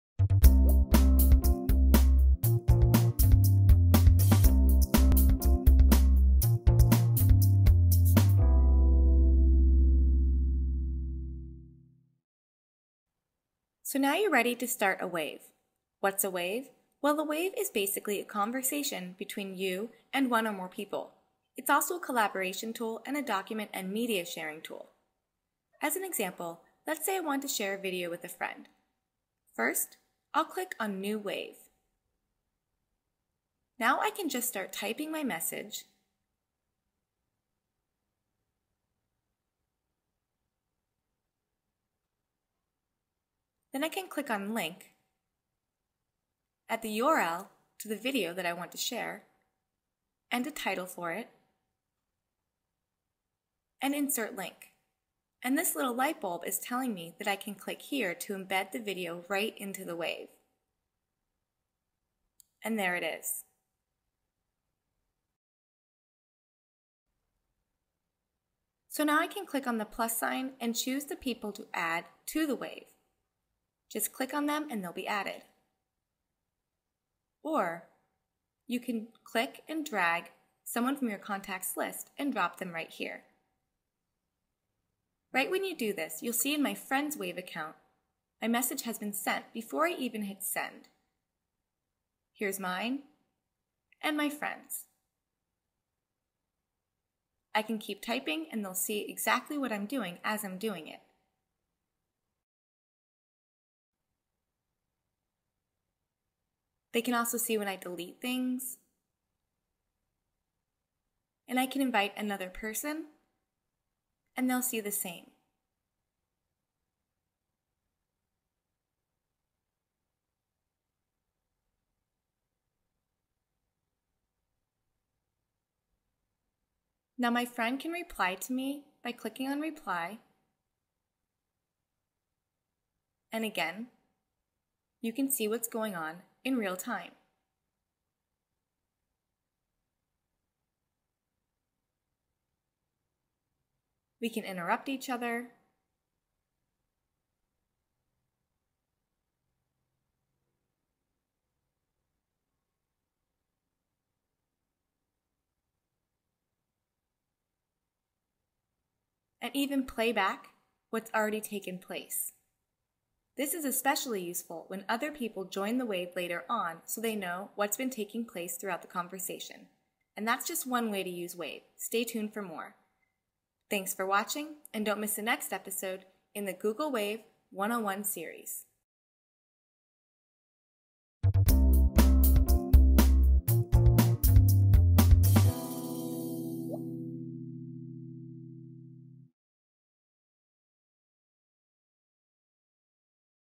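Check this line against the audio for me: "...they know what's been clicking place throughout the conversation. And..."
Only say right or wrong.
wrong.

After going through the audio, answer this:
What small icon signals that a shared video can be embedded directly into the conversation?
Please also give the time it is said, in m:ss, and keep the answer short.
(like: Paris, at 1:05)
light bulb, at 0:55.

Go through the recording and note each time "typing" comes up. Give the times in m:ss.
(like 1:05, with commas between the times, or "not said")
0:34, 1:38.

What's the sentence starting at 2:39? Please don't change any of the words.
And even play back what's already taken place.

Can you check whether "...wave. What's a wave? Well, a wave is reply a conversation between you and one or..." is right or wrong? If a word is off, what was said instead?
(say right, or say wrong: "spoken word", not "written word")
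wrong: "basically", not "reply".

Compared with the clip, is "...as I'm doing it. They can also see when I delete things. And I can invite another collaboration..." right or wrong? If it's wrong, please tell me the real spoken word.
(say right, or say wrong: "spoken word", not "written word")
wrong: "person", not "collaboration".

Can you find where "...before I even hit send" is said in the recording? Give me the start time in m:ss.
1:29.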